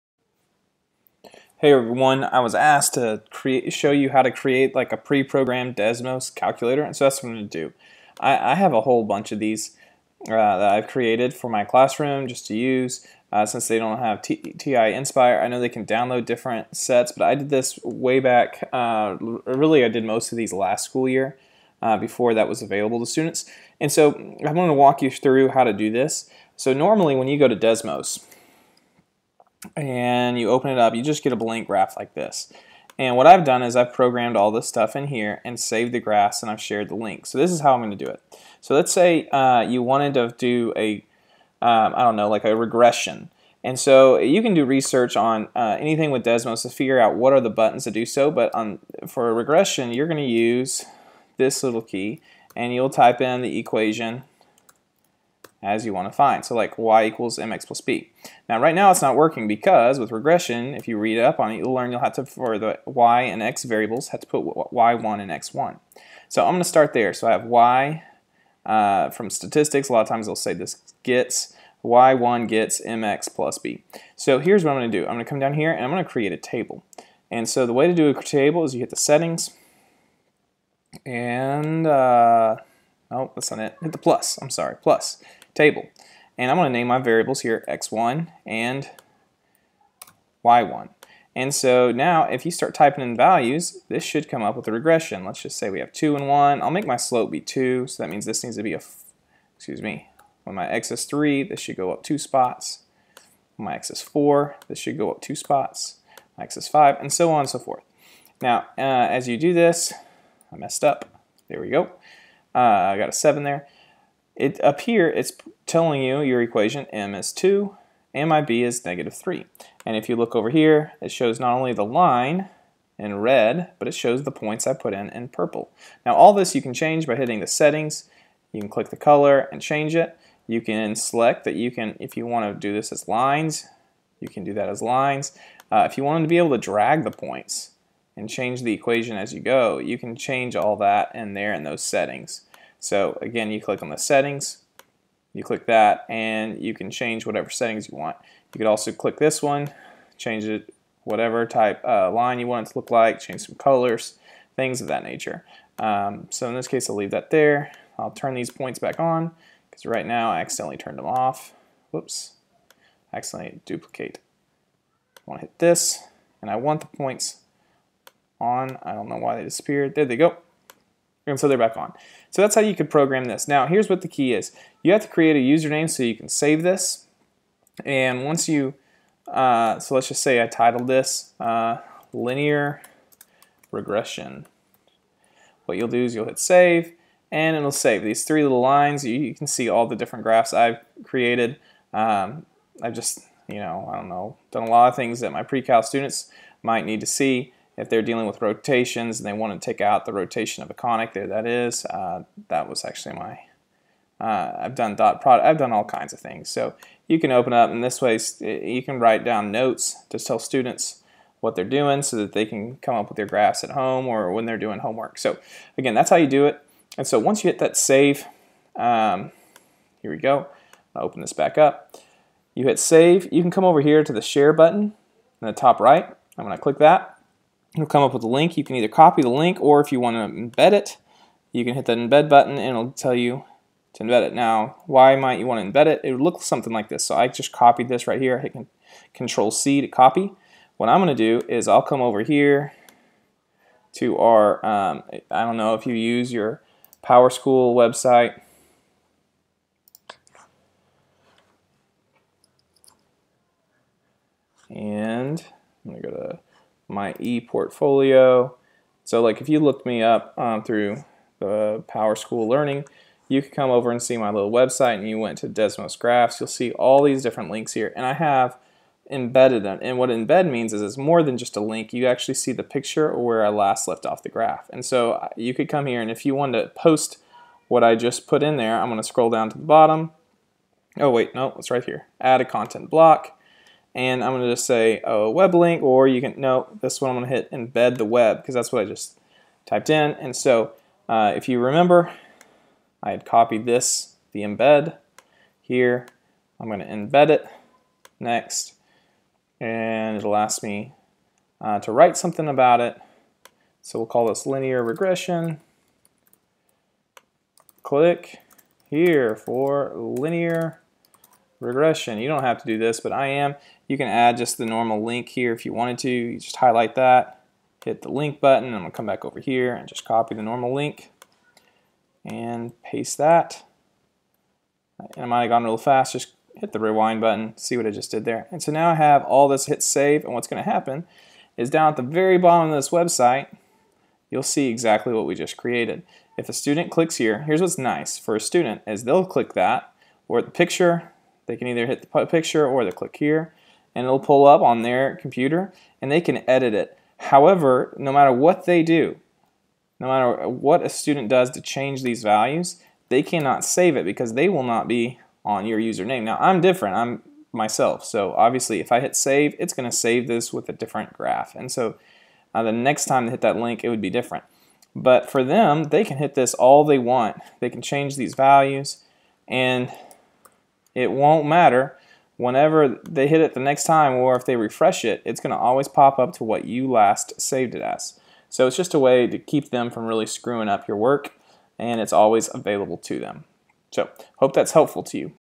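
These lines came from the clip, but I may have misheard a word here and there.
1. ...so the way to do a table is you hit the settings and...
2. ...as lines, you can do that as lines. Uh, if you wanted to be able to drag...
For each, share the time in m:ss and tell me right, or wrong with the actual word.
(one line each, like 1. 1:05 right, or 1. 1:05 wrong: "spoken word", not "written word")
1. 1:17 right
2. 2:12 right.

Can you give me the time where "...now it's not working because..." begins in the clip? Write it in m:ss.
0:58.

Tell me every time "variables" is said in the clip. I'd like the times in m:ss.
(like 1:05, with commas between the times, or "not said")
1:03, 1:26.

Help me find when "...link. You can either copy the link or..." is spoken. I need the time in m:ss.
3:48.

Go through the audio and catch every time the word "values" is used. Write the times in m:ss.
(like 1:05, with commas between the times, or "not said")
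1:33, 5:52, 6:08.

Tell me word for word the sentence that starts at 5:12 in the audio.
You don't have to do this, but I am.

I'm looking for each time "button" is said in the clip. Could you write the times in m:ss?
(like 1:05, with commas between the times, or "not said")
0:47, 3:44, 3:52, 5:18, 5:27.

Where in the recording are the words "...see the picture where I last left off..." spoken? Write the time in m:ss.
4:32.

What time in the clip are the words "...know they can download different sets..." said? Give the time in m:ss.
0:15.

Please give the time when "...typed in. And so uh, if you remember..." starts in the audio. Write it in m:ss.
4:49.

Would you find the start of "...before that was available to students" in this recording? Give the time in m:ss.
0:21.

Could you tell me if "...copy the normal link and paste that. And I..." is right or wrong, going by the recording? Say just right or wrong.
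right.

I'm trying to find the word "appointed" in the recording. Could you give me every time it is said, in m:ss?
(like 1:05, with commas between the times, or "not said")
not said.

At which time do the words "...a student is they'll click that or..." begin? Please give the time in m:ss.
5:38.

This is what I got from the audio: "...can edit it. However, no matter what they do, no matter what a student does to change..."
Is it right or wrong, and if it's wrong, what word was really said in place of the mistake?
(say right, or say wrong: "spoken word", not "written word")
right.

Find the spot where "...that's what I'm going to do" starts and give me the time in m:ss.
0:07.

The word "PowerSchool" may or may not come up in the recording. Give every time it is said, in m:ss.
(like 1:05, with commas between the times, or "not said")
4:07, 4:21.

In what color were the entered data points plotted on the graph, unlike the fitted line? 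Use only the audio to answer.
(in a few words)
purple.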